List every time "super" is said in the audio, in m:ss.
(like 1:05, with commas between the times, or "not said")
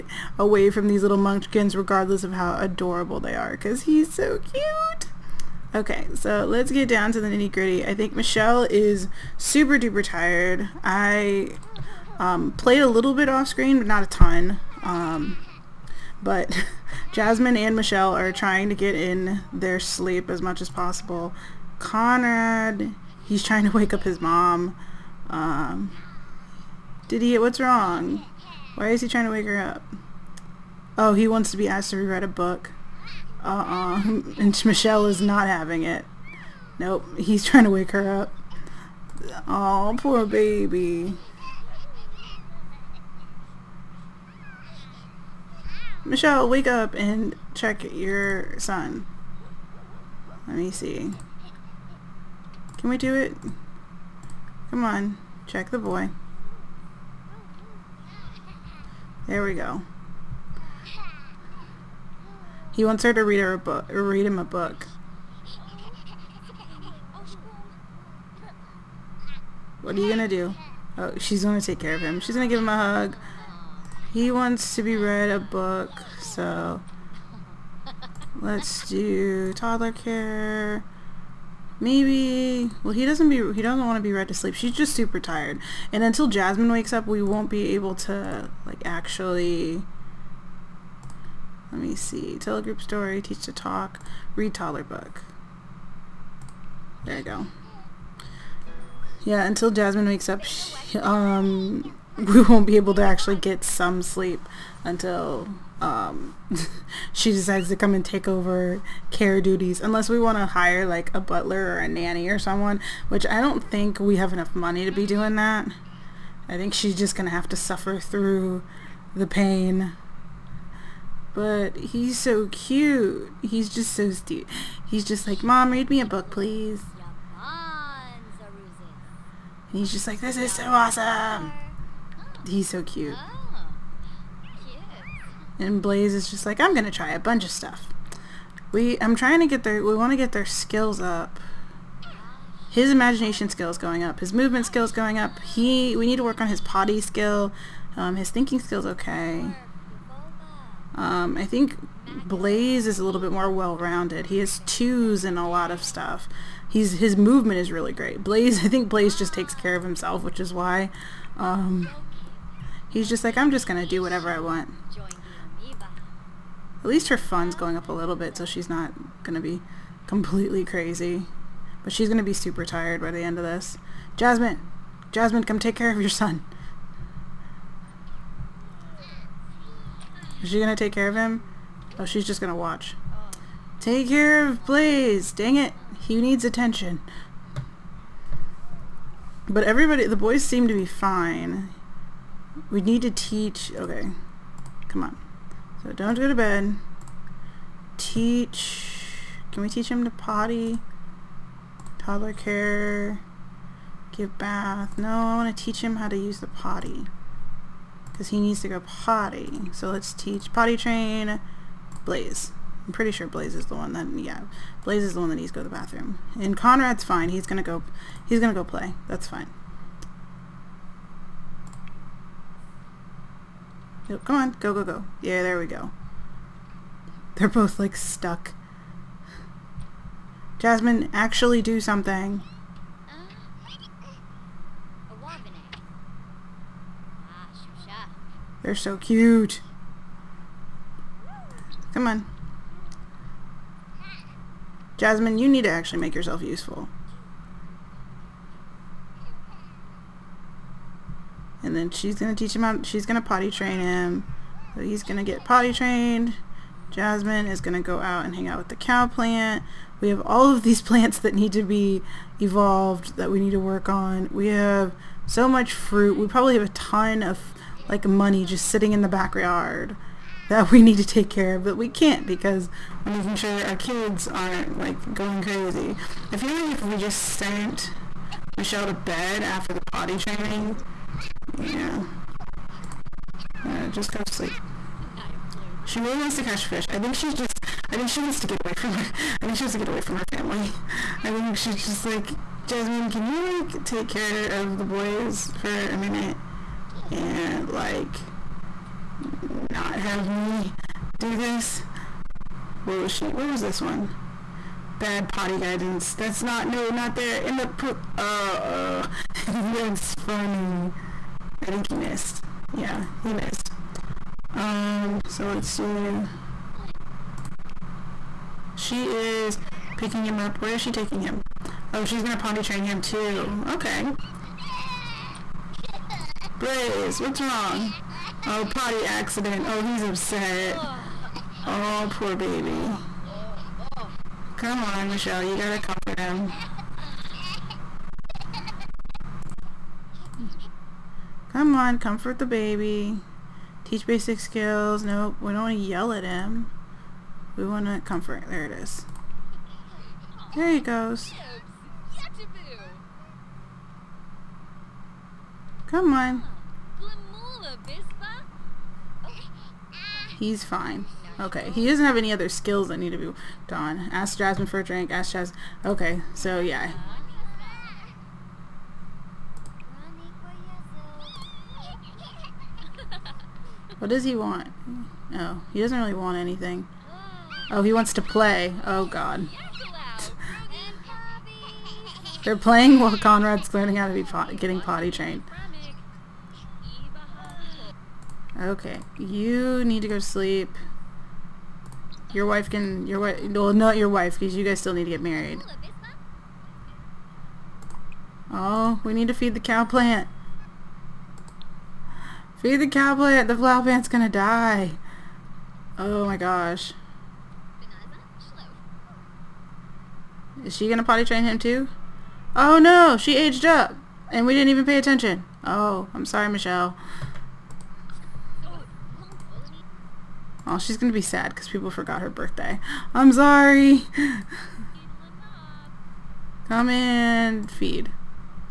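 0:09, 1:24, 2:52.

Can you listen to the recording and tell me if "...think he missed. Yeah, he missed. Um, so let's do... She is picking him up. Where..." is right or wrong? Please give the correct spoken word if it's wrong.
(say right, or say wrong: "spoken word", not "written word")
right.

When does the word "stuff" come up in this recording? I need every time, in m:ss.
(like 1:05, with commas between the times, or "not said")
2:17, 2:35.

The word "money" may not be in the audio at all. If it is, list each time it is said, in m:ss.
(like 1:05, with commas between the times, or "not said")
1:54, 4:28.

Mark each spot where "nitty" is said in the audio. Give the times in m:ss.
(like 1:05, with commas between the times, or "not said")
0:07.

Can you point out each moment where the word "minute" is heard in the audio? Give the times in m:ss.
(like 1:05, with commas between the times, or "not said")
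4:55.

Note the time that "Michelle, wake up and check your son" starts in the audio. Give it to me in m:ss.
0:46.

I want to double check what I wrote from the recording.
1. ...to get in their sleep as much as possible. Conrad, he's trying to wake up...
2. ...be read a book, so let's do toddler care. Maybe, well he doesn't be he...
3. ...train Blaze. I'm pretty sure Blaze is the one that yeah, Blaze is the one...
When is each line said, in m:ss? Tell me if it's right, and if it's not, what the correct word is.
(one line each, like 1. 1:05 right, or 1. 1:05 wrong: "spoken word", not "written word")
1. 0:18 right
2. 1:14 right
3. 3:30 right.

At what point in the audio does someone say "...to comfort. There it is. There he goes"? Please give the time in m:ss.
5:47.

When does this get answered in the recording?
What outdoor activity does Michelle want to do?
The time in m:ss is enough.
4:46.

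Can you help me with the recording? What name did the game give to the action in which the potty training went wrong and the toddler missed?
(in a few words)
Bad potty guidance.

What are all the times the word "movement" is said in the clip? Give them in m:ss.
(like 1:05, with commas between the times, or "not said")
2:24, 2:37.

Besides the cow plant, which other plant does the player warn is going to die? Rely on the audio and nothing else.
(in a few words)
Flower plant.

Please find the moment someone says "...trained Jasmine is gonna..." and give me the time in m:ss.
4:15.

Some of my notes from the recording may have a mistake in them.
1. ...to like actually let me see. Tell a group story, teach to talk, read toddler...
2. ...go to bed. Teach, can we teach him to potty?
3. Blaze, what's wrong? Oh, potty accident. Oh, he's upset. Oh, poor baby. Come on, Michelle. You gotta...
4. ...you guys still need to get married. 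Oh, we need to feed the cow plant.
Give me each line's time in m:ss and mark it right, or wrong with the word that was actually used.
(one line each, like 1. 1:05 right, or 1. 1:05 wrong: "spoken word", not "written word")
1. 1:28 right
2. 3:16 right
3. 5:26 right
4. 6:34 right.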